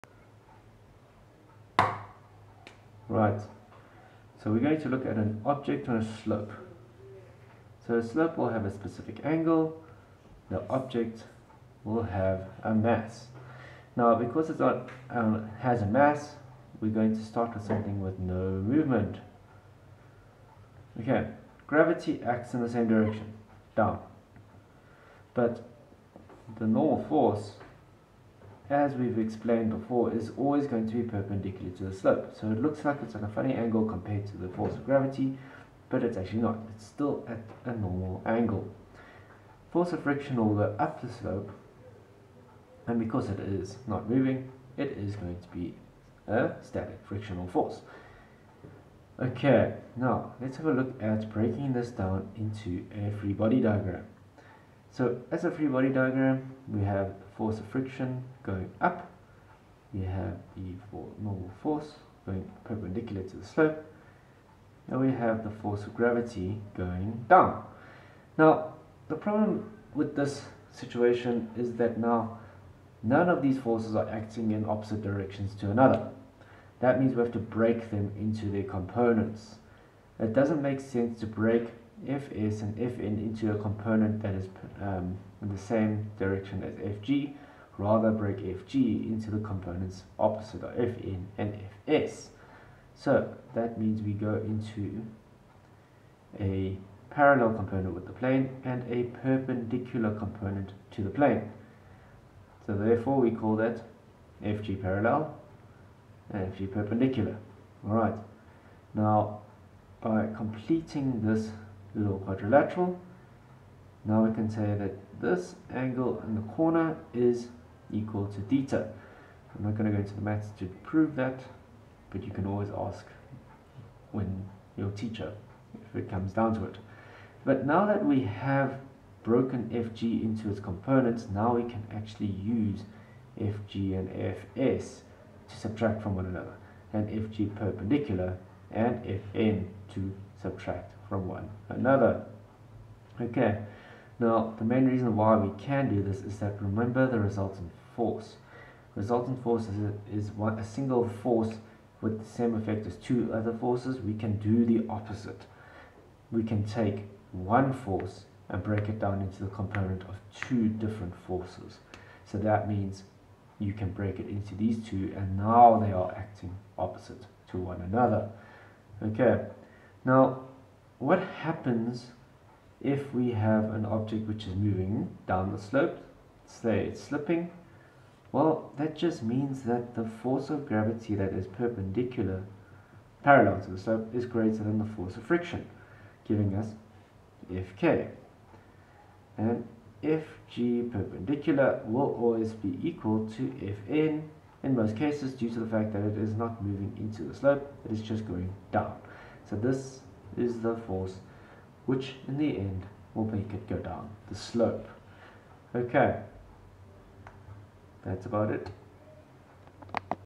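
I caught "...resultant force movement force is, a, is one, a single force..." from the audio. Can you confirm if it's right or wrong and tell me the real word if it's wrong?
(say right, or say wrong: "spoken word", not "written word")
wrong: "resultant", not "movement".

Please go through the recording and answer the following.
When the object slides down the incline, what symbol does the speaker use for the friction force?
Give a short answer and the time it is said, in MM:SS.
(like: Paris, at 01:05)
Fk, at 03:07.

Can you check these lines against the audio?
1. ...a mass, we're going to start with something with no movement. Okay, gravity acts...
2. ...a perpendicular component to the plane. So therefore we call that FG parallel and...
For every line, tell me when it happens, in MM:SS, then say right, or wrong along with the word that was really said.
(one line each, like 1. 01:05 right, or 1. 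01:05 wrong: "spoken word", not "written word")
1. 00:15 right
2. 01:38 right.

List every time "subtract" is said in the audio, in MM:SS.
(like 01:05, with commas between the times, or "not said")
02:15, 02:20.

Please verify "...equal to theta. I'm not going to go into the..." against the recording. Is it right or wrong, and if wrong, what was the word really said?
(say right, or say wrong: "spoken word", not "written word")
right.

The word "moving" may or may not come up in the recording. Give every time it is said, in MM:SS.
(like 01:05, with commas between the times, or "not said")
00:44, 02:54, 03:16.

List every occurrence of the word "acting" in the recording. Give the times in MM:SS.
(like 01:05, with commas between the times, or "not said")
01:14, 02:46.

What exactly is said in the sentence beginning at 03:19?
So this is the force which in the end will make it go down the slope.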